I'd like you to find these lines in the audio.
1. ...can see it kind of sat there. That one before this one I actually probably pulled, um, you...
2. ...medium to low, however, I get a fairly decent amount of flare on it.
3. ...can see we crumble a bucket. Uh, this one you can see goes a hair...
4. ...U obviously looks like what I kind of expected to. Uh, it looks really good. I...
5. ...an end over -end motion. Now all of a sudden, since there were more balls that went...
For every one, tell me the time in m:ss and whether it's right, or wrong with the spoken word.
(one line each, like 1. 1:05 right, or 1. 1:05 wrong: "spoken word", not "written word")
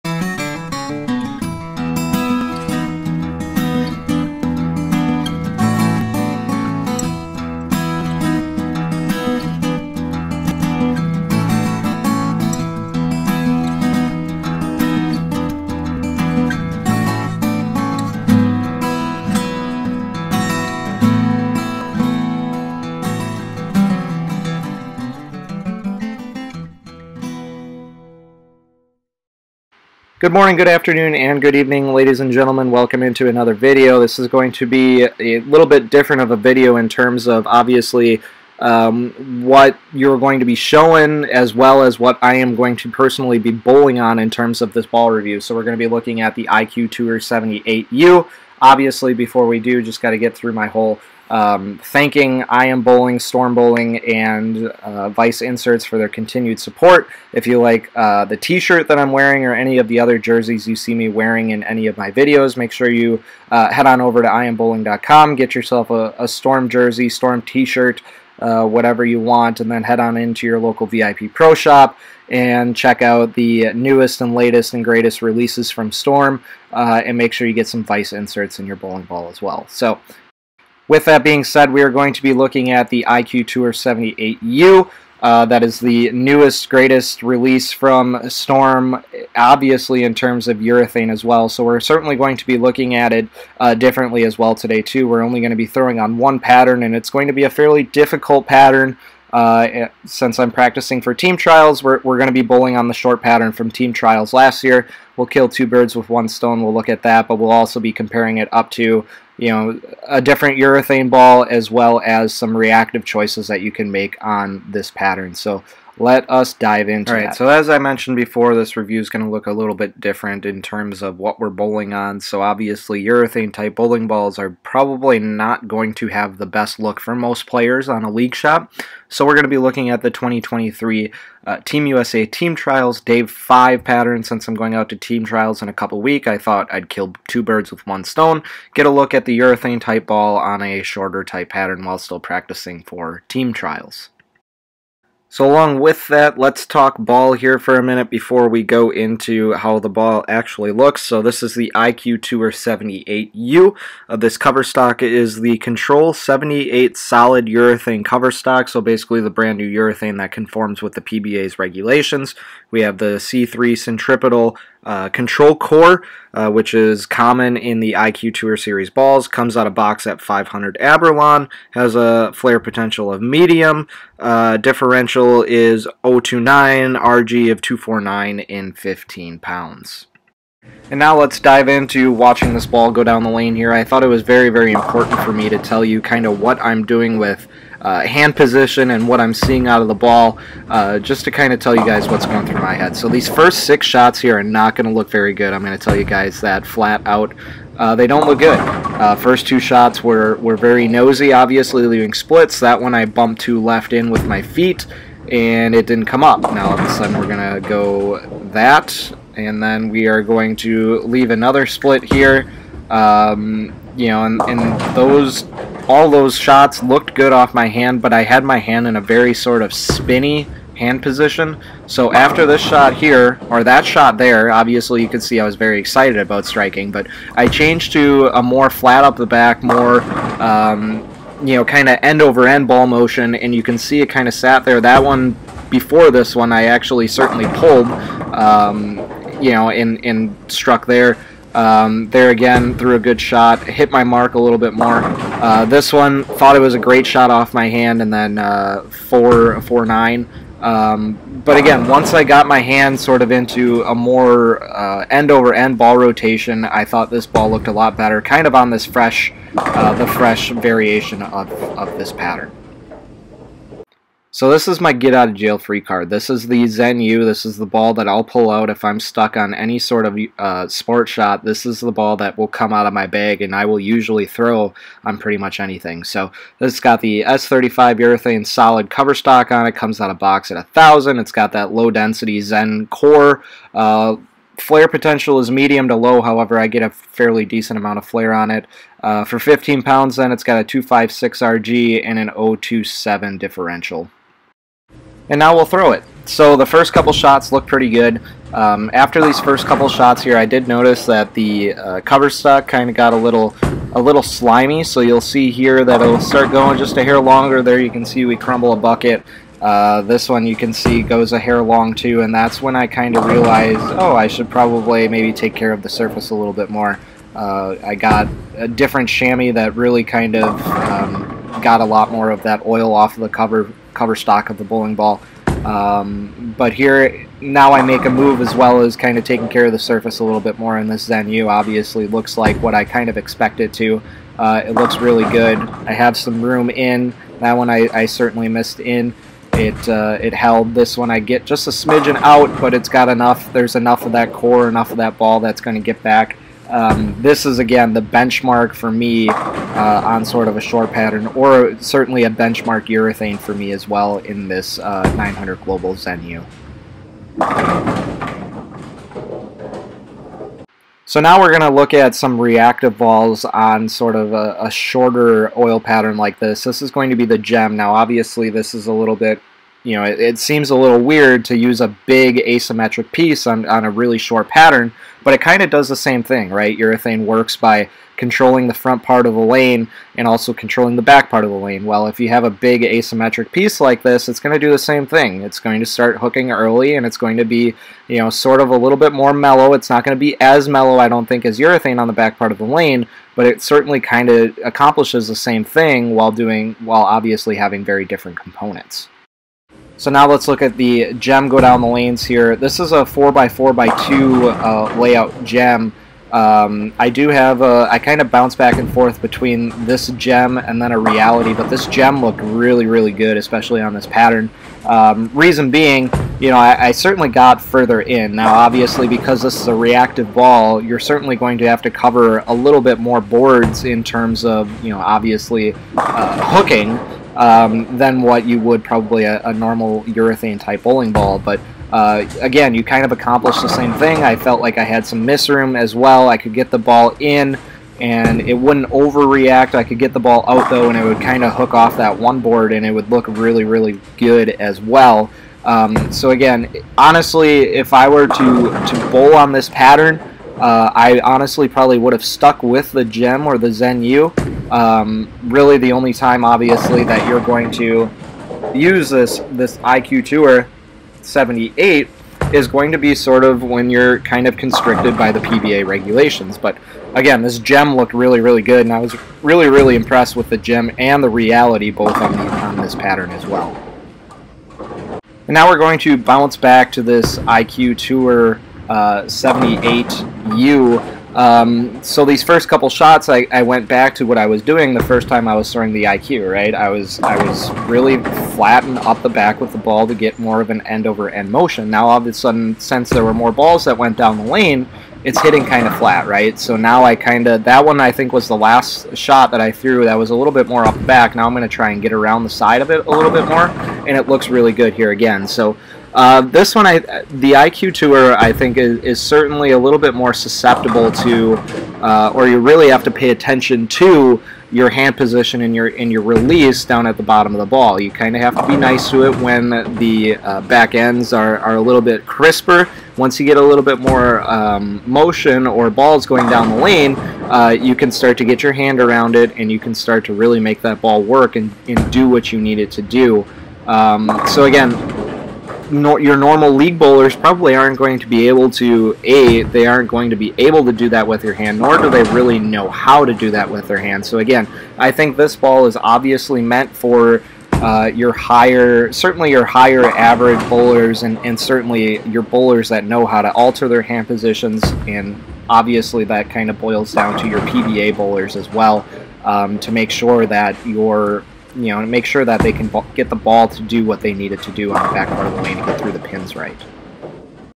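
1. 3:53 wrong: "certainly", not "probably"
2. 4:45 right
3. 5:07 right
4. 5:31 right
5. 8:10 right.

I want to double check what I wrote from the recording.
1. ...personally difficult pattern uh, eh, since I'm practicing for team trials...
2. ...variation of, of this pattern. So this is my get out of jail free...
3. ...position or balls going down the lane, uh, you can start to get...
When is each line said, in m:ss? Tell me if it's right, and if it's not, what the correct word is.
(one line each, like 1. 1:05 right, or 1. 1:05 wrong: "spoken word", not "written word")
1. 1:37 wrong: "fairly", not "personally"
2. 4:20 right
3. 8:45 wrong: "motion", not "position".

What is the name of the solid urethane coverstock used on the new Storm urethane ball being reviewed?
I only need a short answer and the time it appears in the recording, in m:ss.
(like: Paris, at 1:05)
Control 78, at 2:35.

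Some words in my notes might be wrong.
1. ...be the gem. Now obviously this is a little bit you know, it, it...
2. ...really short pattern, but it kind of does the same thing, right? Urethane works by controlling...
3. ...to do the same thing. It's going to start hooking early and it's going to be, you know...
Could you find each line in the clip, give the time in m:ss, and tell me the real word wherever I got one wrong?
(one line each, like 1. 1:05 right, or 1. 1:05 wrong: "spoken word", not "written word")
1. 6:07 right
2. 6:13 right
3. 6:24 right.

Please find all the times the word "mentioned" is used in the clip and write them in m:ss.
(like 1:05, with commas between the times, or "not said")
1:57.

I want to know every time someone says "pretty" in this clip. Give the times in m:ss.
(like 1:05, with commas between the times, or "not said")
4:35, 4:57.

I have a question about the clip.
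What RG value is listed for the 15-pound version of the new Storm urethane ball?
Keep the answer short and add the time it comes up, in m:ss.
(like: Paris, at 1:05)
2.49, at 2:57.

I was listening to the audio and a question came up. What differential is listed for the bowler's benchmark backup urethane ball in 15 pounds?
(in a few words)
0.027.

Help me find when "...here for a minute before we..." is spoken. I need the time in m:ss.
2:27.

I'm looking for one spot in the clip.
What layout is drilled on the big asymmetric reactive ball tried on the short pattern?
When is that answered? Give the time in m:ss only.
6:43.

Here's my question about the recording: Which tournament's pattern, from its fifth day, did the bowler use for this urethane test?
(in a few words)
Team USA Team Trials.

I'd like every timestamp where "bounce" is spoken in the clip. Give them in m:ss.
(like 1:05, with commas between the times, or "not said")
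6:48, 7:56.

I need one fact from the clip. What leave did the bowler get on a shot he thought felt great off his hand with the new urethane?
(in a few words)
4-4-9.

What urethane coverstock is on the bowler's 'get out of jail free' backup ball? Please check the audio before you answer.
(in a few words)
S35.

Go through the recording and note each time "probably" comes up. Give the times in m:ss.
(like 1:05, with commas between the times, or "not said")
2:04, 5:14, 7:08, 7:31, 8:57.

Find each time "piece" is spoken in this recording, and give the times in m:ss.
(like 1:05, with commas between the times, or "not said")
6:13, 6:23.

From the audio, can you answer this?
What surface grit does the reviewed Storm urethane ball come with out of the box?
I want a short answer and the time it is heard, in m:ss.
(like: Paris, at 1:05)
500 Abralon, at 2:50.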